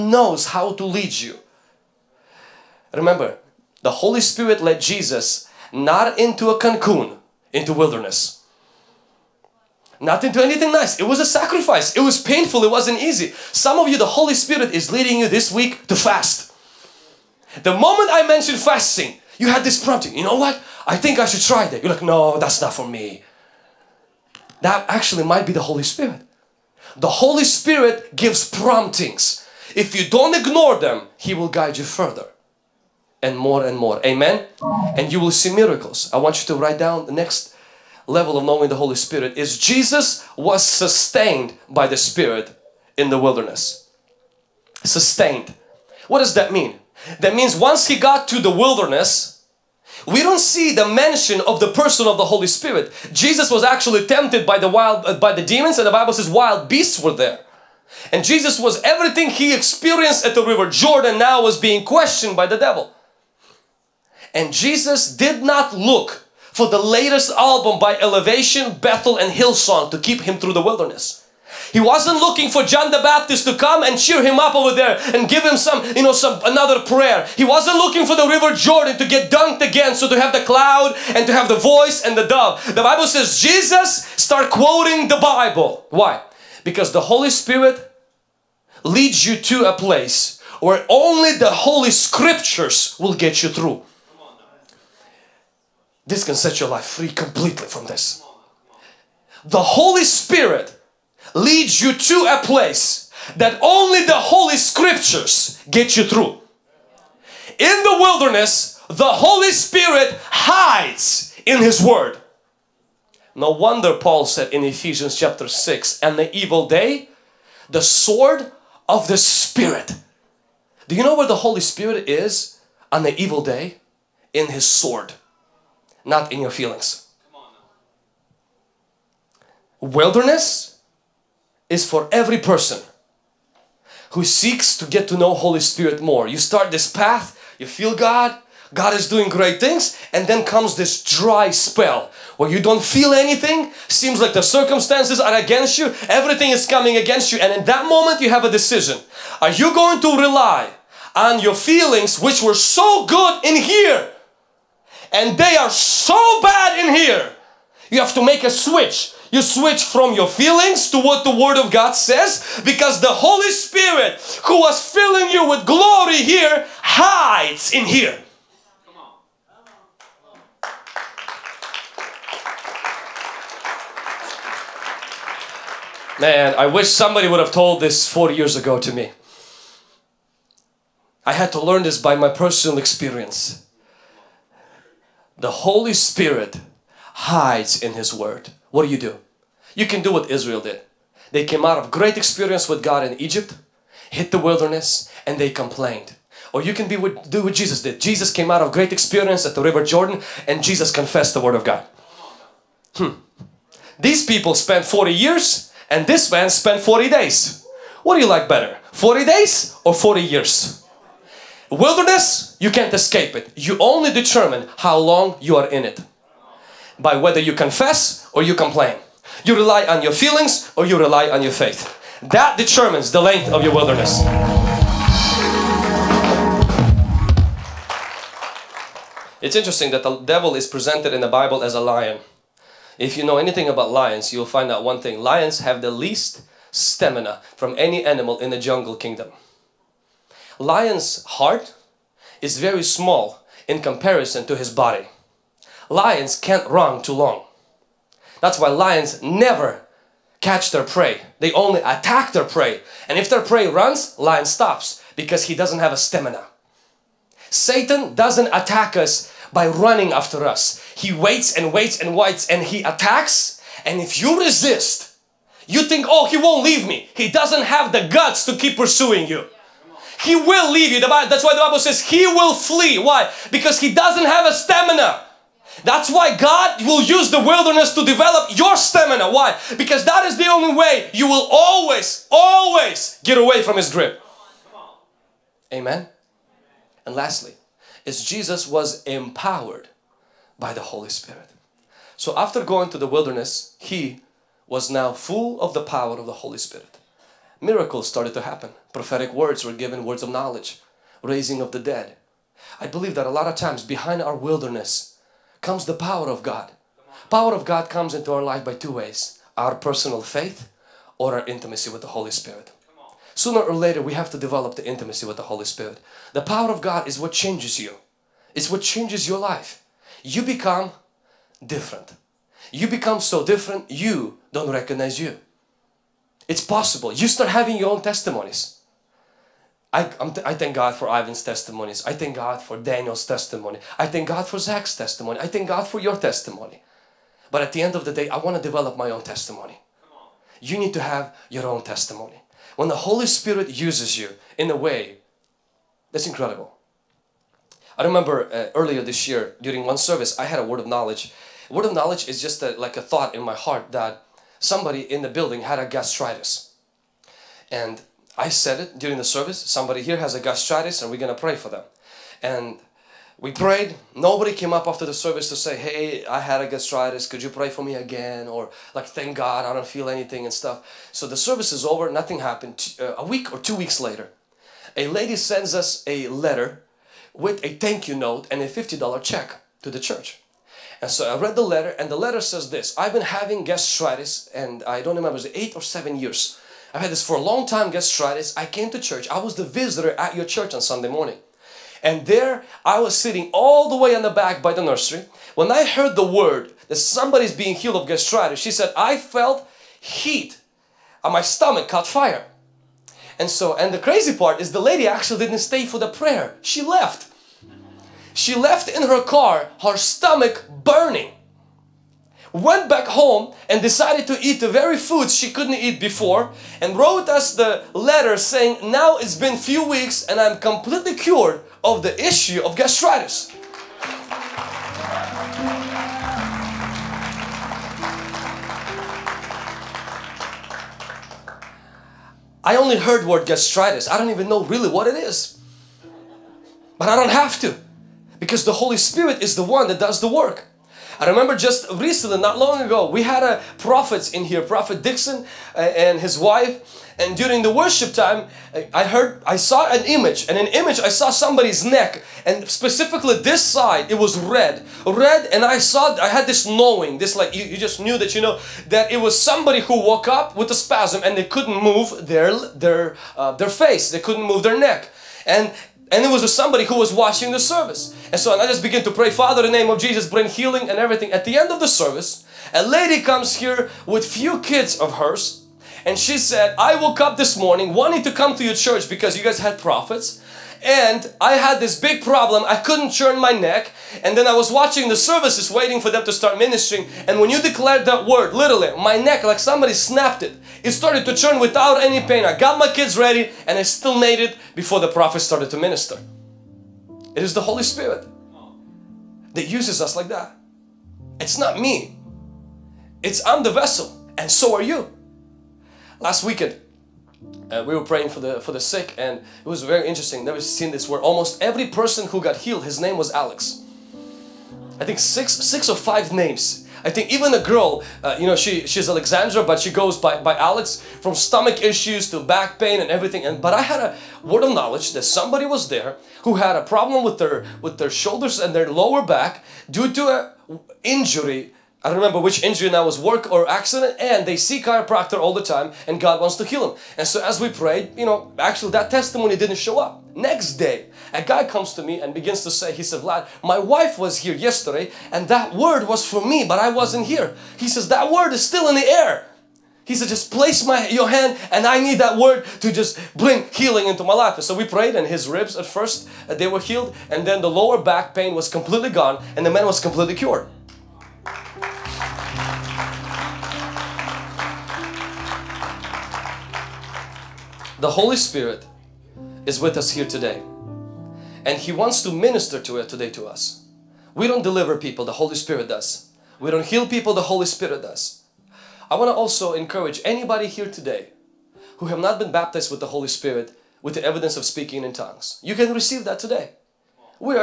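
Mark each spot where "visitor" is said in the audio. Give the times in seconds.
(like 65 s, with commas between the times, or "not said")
389 s.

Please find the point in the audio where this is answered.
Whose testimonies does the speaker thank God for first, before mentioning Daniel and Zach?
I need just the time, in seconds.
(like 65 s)
331 s.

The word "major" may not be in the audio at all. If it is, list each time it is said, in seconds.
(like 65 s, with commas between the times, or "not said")
not said.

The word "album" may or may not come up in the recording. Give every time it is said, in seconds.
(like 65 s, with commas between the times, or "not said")
67 s.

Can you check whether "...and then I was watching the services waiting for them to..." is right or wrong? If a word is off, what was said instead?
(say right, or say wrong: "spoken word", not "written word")
right.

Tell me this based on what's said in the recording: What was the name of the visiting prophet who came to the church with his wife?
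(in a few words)
Dixon.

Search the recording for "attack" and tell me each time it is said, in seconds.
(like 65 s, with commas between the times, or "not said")
251 s, 258 s, 262 s.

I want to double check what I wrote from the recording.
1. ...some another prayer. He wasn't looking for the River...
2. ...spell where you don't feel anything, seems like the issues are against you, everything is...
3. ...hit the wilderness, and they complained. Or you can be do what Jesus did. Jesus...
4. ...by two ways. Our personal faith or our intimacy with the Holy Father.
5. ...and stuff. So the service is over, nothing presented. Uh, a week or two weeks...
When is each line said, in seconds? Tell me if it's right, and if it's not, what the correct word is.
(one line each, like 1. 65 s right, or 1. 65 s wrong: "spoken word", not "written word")
1. 76 s right
2. 141 s wrong: "circumstances", not "issues"
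3. 194 s right
4. 308 s wrong: "Spirit", not "Father"
5. 370 s wrong: "happened", not "presented".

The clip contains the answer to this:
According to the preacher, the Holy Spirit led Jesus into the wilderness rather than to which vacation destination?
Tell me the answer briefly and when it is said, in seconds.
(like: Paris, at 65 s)
Cancun, at 6 s.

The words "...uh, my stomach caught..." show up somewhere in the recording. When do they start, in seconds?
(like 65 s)
401 s.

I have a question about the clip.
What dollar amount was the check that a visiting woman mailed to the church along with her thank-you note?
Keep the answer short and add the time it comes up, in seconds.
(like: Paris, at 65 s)
$50, at 378 s.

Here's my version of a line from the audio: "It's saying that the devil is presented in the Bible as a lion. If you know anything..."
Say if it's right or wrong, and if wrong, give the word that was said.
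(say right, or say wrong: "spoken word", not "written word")
wrong: "interesting", not "saying".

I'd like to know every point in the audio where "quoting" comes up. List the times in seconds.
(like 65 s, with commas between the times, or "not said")
84 s.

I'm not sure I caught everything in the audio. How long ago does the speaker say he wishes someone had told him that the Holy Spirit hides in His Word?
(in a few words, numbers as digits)
four years ago.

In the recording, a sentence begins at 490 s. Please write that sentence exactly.
It started to turn without any pain.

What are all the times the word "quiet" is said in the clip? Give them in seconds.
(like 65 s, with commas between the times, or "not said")
not said.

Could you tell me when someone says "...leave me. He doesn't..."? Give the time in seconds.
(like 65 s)
266 s.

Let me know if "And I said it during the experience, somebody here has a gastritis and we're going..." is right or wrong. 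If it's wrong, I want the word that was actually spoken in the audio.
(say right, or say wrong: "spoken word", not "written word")
wrong: "service", not "experience".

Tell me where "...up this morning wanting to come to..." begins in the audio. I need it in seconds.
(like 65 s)
477 s.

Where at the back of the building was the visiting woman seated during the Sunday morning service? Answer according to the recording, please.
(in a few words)
the nursery.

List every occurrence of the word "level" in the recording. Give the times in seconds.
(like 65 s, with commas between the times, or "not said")
38 s.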